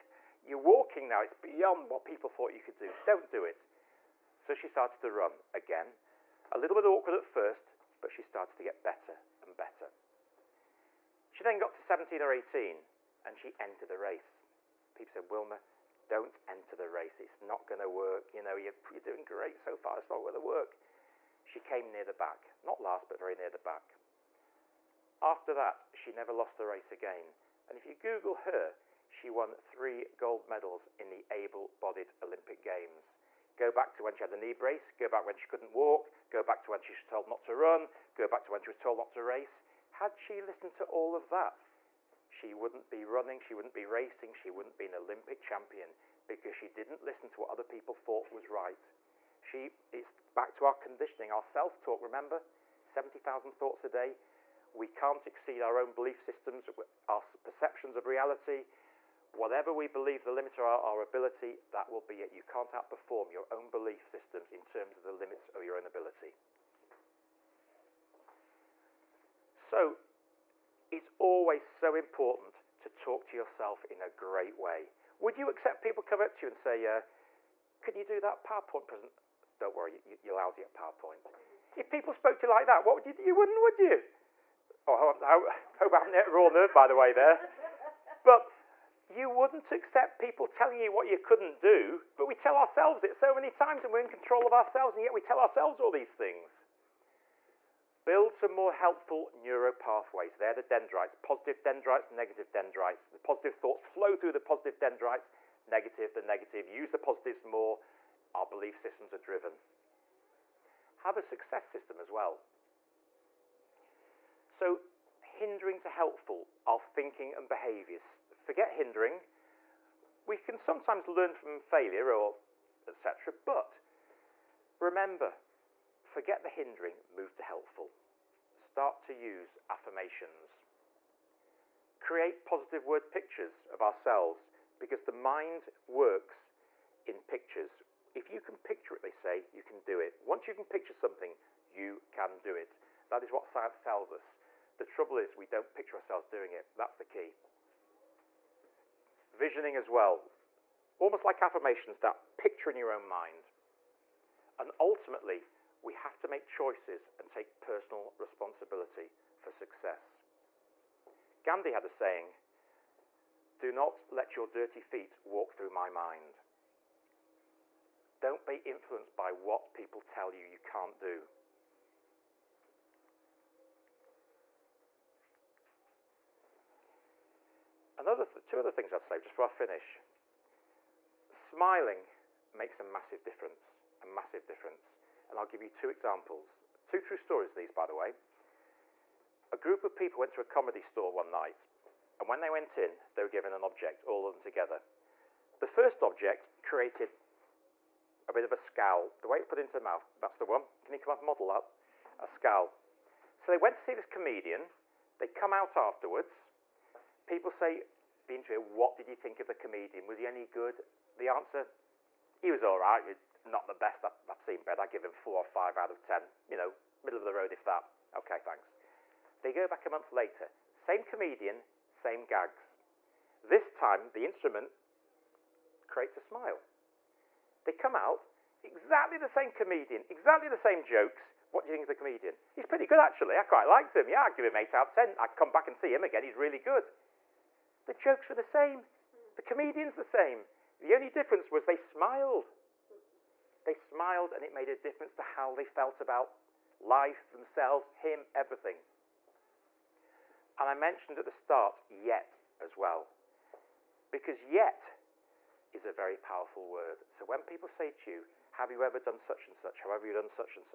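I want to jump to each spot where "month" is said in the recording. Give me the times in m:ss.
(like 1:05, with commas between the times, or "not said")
3:39.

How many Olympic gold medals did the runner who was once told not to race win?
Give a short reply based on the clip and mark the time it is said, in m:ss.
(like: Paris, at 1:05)
3, at 0:29.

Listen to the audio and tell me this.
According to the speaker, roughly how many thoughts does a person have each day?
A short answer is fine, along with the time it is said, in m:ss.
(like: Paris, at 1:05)
70,000, at 0:52.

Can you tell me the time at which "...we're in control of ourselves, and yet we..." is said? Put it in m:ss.
1:33.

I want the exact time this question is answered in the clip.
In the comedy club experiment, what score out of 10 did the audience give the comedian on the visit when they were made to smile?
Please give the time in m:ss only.
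3:54.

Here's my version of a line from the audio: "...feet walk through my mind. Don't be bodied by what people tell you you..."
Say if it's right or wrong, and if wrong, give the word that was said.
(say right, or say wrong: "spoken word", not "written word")
wrong: "influenced", not "bodied".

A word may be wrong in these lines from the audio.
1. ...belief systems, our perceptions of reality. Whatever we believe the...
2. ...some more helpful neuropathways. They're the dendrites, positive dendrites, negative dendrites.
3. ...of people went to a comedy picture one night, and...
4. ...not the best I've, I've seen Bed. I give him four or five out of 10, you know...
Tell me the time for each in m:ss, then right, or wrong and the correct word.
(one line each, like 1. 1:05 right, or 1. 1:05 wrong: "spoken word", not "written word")
1. 0:55 right
2. 1:38 right
3. 3:09 wrong: "store", not "picture"
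4. 3:33 right.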